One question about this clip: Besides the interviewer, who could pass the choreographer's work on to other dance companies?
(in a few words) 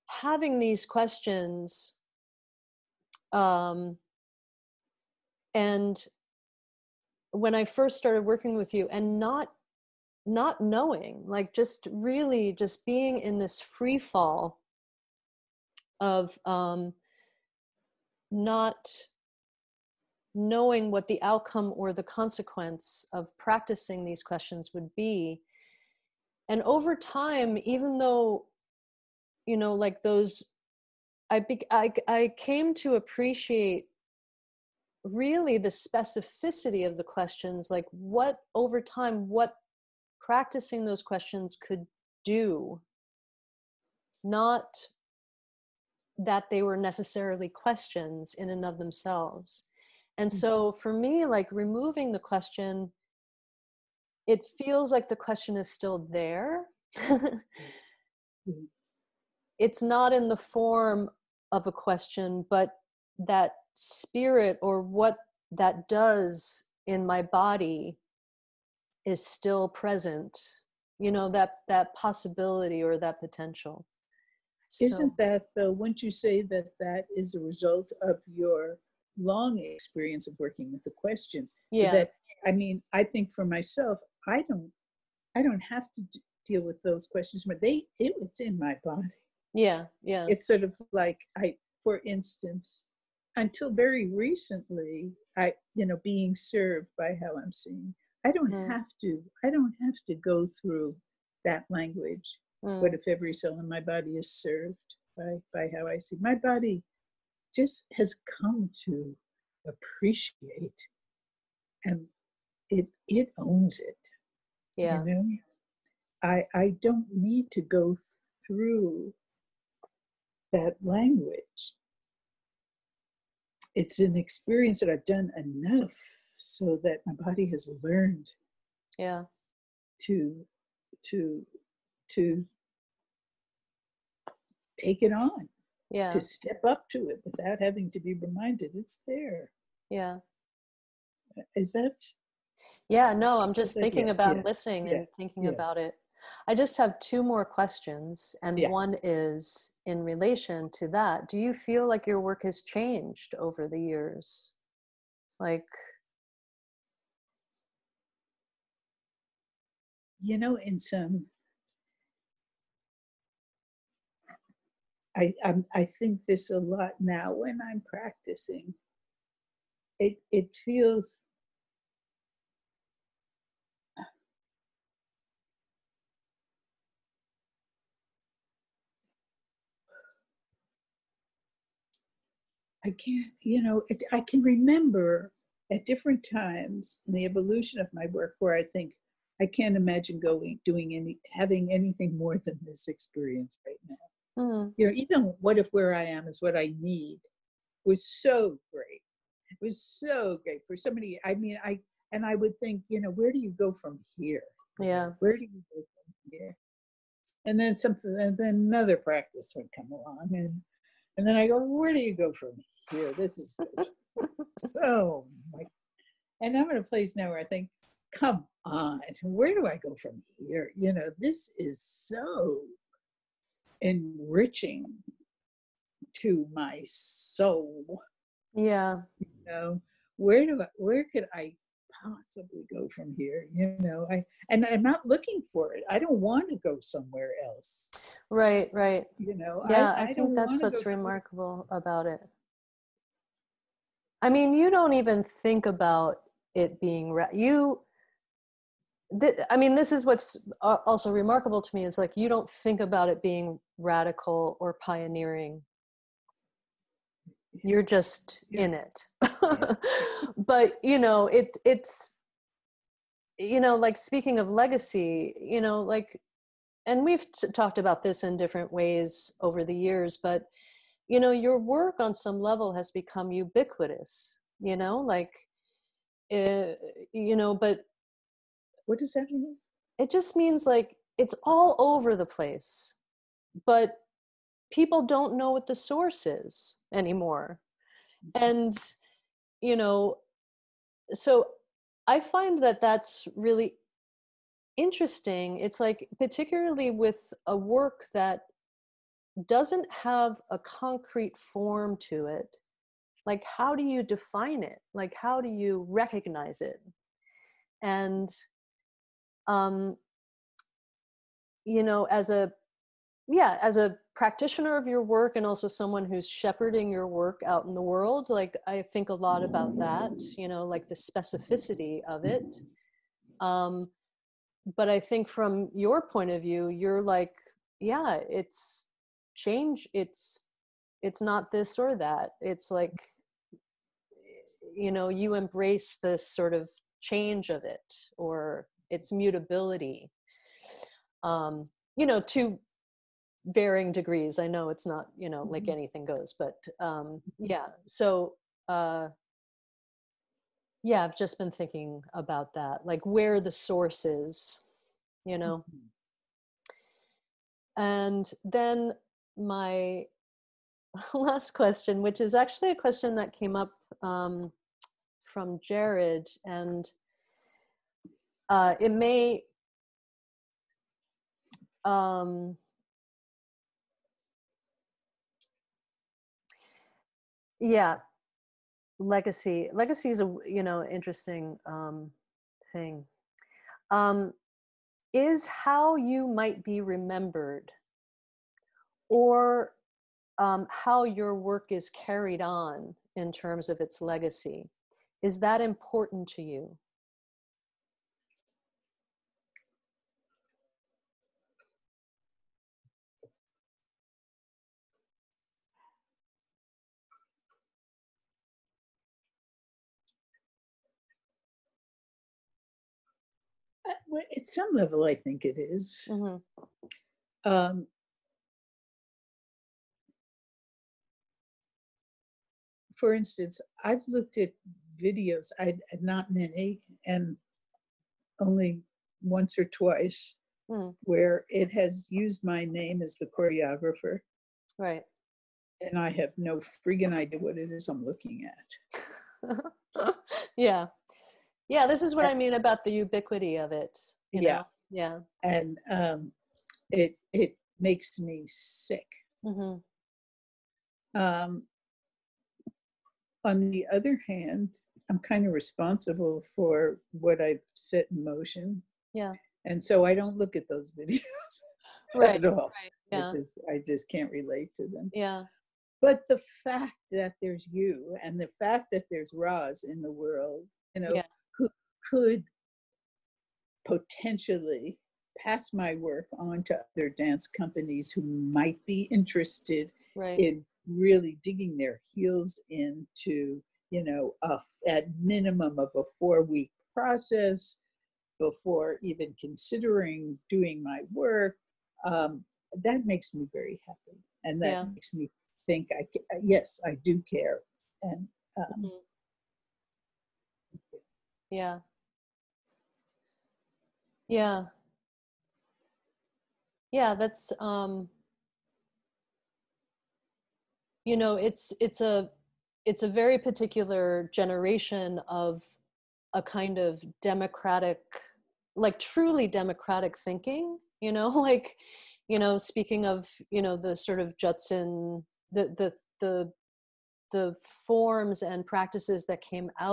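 Ros.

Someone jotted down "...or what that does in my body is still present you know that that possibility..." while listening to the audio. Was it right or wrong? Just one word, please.
right.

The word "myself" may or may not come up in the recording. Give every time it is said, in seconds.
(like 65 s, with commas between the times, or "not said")
83 s.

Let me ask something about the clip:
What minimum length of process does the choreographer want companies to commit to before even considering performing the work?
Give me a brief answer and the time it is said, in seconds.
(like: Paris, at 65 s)
4 weeks, at 486 s.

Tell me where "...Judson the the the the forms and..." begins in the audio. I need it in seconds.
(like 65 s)
524 s.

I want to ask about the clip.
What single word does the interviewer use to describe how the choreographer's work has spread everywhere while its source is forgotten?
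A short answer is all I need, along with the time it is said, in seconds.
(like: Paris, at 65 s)
Ubiquitous, at 273 s.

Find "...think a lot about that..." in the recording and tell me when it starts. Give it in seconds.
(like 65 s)
318 s.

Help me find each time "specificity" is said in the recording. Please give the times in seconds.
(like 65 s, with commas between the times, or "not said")
35 s, 320 s.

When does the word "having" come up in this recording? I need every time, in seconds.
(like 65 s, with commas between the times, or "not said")
0 s, 137 s, 191 s.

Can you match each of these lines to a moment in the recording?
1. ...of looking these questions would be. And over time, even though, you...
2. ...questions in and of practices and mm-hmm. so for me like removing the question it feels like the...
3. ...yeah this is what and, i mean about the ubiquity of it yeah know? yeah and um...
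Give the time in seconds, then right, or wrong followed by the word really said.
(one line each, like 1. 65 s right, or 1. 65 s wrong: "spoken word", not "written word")
1. 23 s wrong: "practicing", not "looking"
2. 47 s wrong: "themselves", not "practices"
3. 441 s right.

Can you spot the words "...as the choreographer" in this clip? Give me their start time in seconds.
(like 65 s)
433 s.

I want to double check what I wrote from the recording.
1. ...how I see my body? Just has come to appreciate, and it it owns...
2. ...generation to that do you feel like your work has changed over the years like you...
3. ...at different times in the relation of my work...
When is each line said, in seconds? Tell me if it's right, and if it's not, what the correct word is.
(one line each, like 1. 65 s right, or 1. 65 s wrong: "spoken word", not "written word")
1. 105 s right
2. 150 s wrong: "relation", not "generation"
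3. 185 s wrong: "evolution", not "relation".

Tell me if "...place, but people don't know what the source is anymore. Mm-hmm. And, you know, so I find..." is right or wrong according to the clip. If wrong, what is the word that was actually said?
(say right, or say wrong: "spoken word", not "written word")
right.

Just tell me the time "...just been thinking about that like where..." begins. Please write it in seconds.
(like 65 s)
351 s.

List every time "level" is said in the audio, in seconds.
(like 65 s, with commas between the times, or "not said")
272 s, 414 s.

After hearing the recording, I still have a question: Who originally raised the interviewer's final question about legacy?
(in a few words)
Jared.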